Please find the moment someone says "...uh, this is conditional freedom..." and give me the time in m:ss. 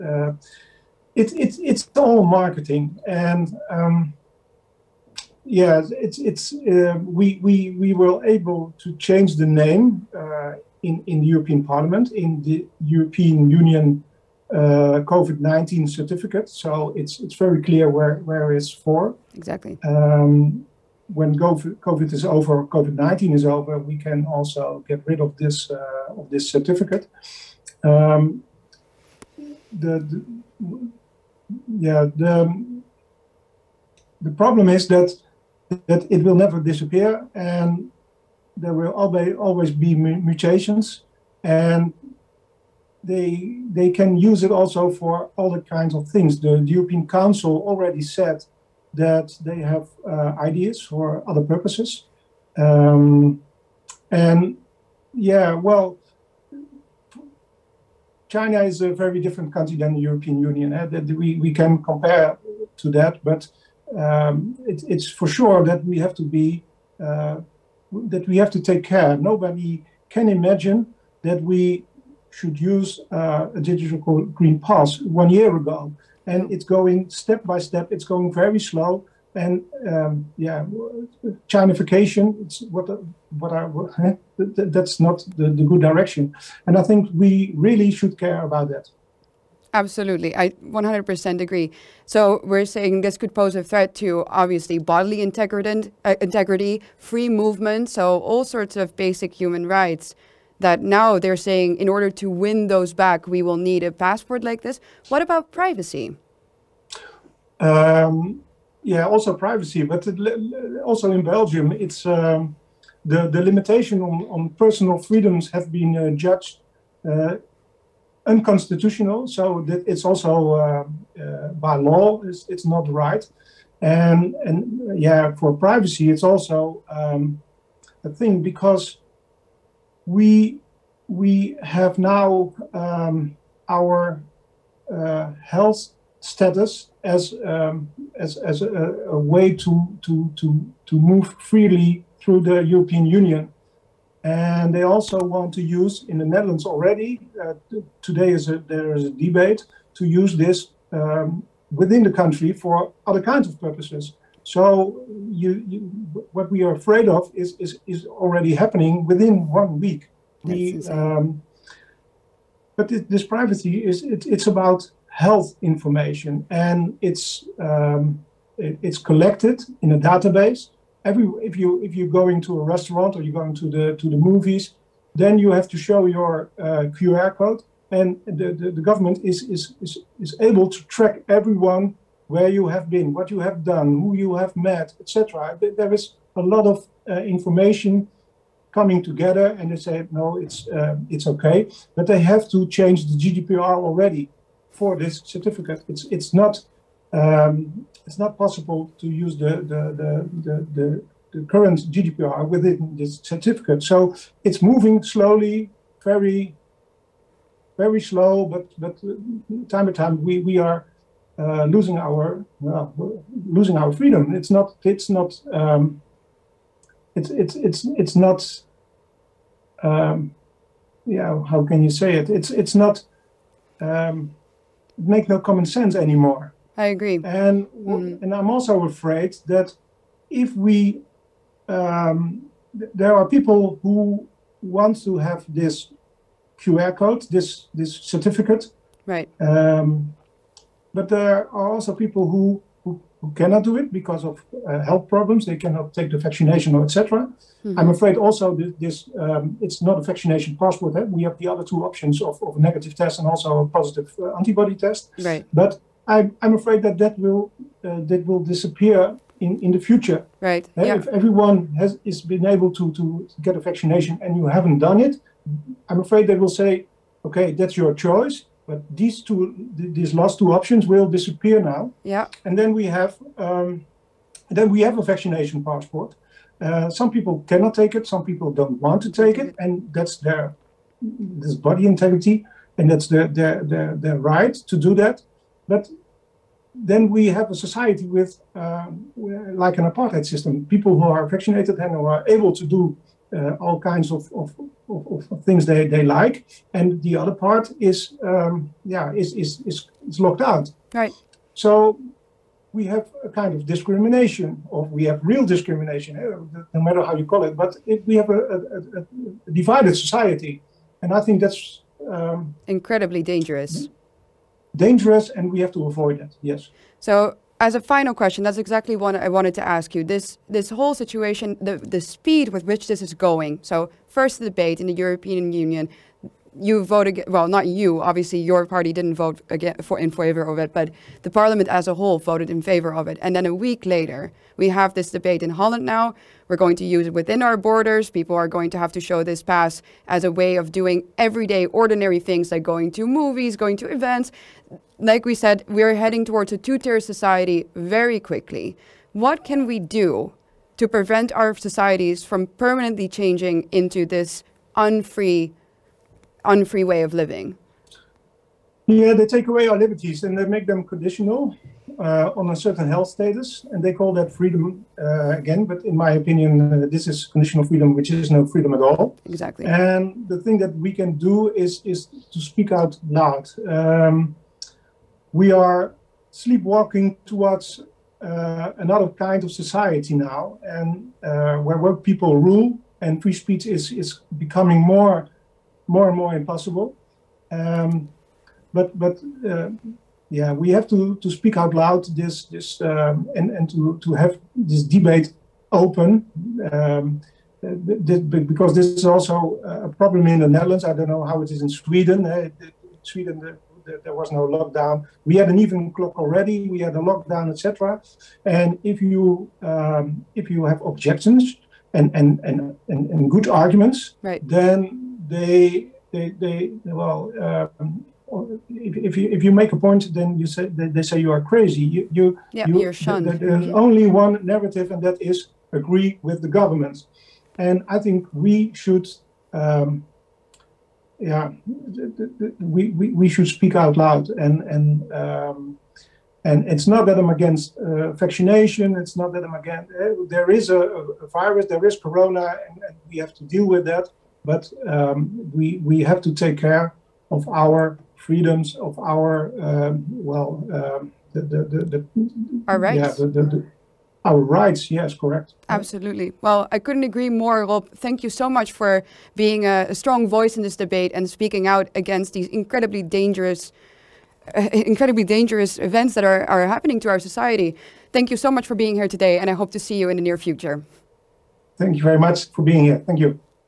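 6:06.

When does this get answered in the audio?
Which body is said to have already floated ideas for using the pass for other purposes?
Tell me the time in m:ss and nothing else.
0:46.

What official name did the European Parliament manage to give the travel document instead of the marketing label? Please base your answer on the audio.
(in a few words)
COVID-19 certificate.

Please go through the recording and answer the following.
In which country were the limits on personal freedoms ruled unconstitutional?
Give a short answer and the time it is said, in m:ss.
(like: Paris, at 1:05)
Belgium, at 1:51.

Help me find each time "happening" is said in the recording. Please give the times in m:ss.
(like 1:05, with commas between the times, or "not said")
2:38, 7:46.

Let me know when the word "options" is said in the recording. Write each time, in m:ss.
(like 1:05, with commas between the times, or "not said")
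4:11, 4:30.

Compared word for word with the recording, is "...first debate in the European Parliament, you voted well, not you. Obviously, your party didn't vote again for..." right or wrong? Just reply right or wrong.
wrong.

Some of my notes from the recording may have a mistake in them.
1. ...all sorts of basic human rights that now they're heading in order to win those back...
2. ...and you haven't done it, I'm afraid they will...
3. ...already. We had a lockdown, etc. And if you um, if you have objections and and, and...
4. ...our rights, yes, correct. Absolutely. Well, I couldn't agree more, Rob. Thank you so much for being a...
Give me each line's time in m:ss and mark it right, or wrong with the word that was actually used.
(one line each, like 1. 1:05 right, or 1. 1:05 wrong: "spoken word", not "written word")
1. 1:38 wrong: "saying", not "heading"
2. 4:24 right
3. 6:46 right
4. 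7:34 right.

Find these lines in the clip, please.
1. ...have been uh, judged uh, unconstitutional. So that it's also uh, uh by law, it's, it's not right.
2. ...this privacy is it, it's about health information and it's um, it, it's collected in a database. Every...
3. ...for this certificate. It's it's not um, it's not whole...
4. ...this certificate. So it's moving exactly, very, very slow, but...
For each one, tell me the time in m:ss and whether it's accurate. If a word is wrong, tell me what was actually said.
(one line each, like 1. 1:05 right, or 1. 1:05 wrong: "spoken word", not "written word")
1. 1:55 right
2. 2:43 right
3. 3:14 wrong: "possible", not "whole"
4. 3:22 wrong: "slowly", not "exactly".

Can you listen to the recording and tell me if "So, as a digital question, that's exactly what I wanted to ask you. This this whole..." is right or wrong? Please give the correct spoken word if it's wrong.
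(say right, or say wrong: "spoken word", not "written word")
wrong: "final", not "digital".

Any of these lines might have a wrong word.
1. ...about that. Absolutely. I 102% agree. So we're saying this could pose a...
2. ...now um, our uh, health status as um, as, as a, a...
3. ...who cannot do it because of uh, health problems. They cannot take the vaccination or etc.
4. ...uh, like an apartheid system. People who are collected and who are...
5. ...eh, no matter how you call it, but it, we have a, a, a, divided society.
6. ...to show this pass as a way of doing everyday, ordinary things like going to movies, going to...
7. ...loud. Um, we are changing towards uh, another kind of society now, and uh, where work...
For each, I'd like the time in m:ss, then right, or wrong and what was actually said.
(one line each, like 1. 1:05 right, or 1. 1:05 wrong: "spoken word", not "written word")
1. 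1:28 wrong: "100", not "102"
2. 2:11 right
3. 4:03 right
4. 4:48 wrong: "vaccinated", not "collected"
5. 5:06 right
6. 5:38 right
7. 6:13 wrong: "sleepwalking", not "changing".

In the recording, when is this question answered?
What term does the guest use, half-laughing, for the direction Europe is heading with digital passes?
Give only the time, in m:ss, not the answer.
1:21.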